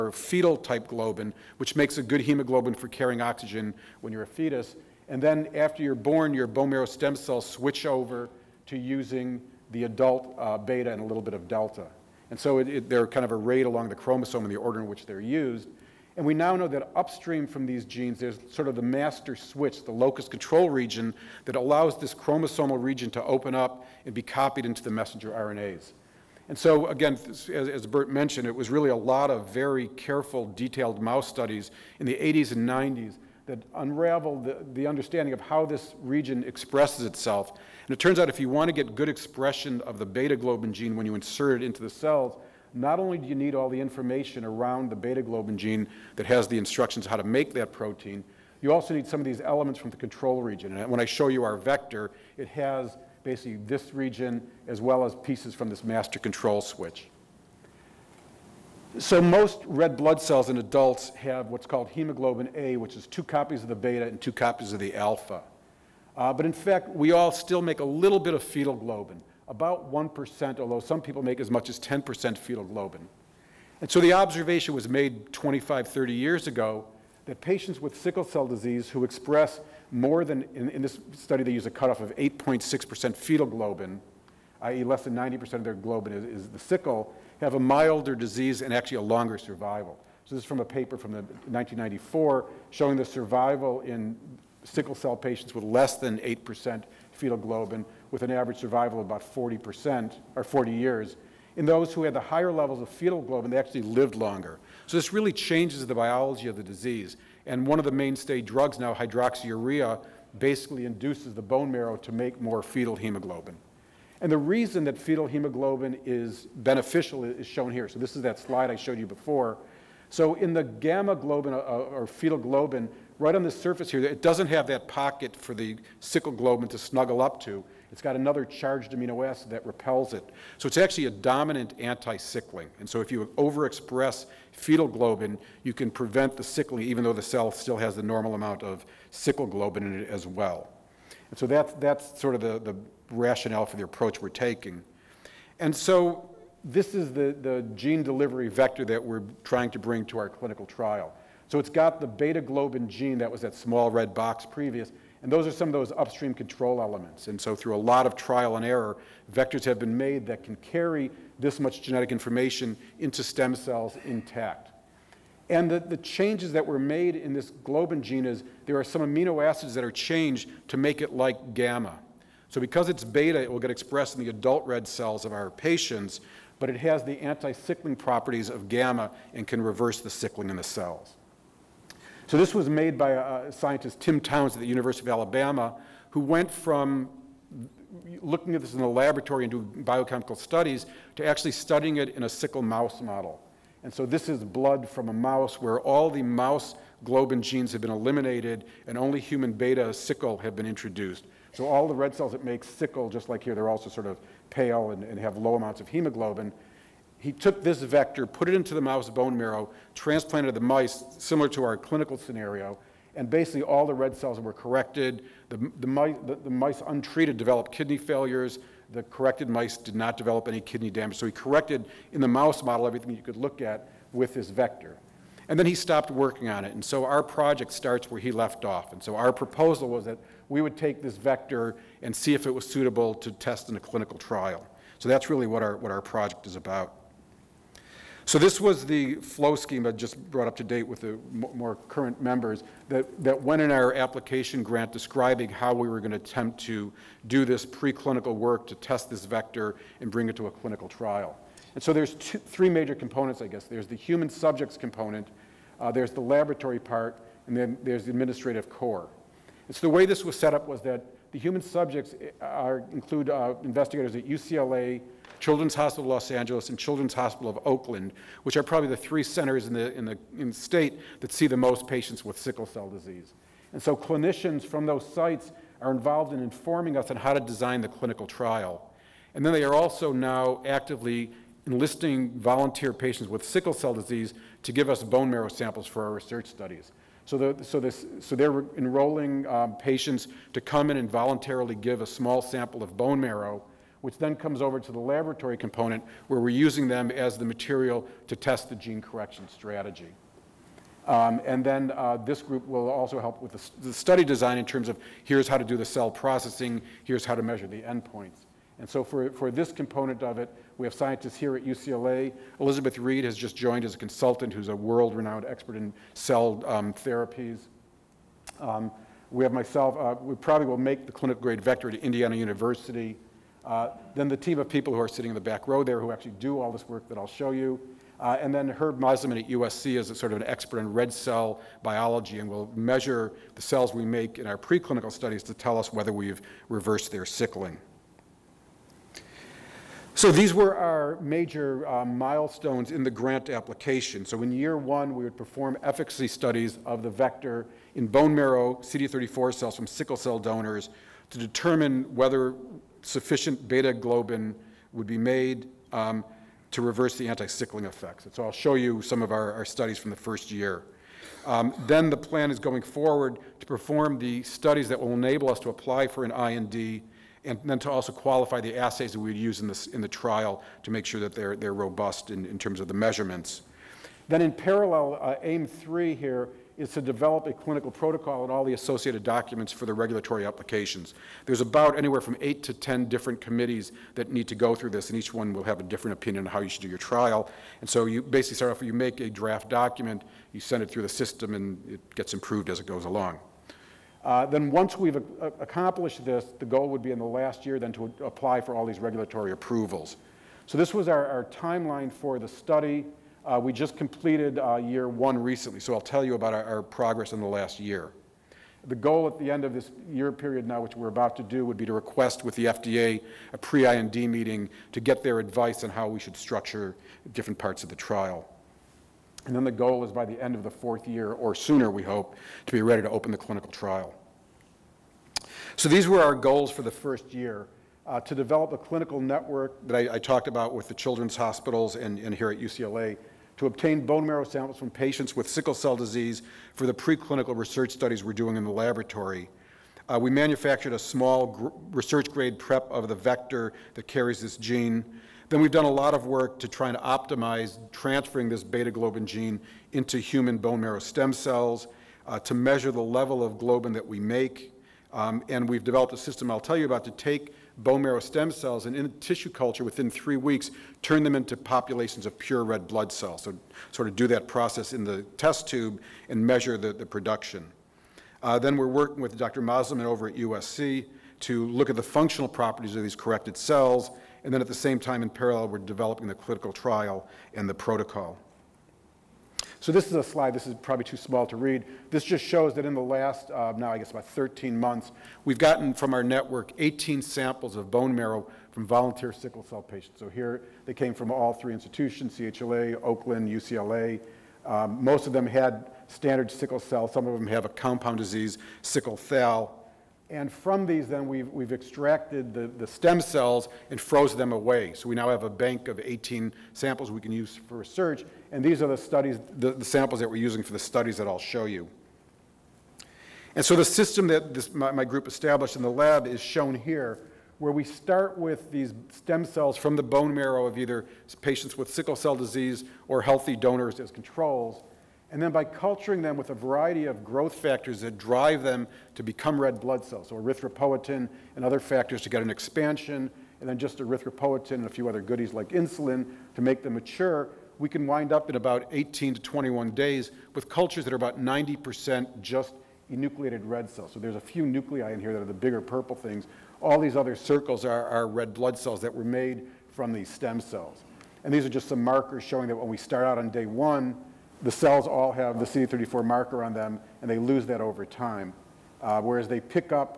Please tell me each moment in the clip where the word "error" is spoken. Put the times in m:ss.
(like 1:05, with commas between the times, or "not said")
2:38.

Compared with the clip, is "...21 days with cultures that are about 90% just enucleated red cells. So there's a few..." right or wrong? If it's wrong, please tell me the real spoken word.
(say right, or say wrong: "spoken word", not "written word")
right.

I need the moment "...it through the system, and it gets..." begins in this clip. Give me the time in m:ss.
6:30.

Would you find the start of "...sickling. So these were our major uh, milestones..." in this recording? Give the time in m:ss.
5:37.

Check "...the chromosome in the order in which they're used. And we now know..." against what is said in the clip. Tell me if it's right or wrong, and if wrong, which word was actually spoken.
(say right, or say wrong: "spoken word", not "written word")
right.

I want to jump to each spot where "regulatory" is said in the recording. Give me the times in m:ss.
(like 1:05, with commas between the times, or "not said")
6:19, 6:38.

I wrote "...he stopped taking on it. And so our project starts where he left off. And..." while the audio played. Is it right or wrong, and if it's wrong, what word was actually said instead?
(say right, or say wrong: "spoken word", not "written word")
wrong: "working", not "taking".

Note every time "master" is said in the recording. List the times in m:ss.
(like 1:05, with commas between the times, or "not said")
0:18, 0:55.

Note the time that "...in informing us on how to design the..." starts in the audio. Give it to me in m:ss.
4:36.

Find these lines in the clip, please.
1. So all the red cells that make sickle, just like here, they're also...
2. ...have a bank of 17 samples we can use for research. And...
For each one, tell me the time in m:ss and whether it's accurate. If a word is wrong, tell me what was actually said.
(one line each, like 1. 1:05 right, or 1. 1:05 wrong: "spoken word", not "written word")
1. 3:21 right
2. 8:25 wrong: "18", not "17".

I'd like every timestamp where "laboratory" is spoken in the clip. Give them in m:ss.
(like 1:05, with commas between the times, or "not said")
3:08, 4:16, 4:54, 7:18.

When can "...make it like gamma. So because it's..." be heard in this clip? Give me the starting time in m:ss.
2:50.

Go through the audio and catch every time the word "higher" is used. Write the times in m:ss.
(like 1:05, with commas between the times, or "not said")
1:42.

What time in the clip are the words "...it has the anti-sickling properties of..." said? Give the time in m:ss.
2:56.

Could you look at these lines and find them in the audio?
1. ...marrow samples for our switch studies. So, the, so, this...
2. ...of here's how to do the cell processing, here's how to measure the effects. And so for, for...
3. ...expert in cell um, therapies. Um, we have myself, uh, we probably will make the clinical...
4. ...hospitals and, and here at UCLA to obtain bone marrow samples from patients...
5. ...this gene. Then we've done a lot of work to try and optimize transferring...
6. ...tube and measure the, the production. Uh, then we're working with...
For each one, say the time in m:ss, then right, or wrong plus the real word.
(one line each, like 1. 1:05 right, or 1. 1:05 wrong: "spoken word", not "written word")
1. 4:45 wrong: "research", not "switch"
2. 5:04 wrong: "endpoints", not "effects"
3. 5:15 right
4. 7:11 right
5. 7:24 right
6. 7:45 right.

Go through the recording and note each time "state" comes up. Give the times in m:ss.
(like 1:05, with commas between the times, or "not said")
4:30.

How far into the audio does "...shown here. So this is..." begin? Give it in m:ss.
1:57.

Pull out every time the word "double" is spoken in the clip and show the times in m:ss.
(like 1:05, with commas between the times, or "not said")
not said.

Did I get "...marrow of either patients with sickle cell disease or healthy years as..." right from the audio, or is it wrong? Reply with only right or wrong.
wrong.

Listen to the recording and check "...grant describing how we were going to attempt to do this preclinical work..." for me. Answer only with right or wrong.
right.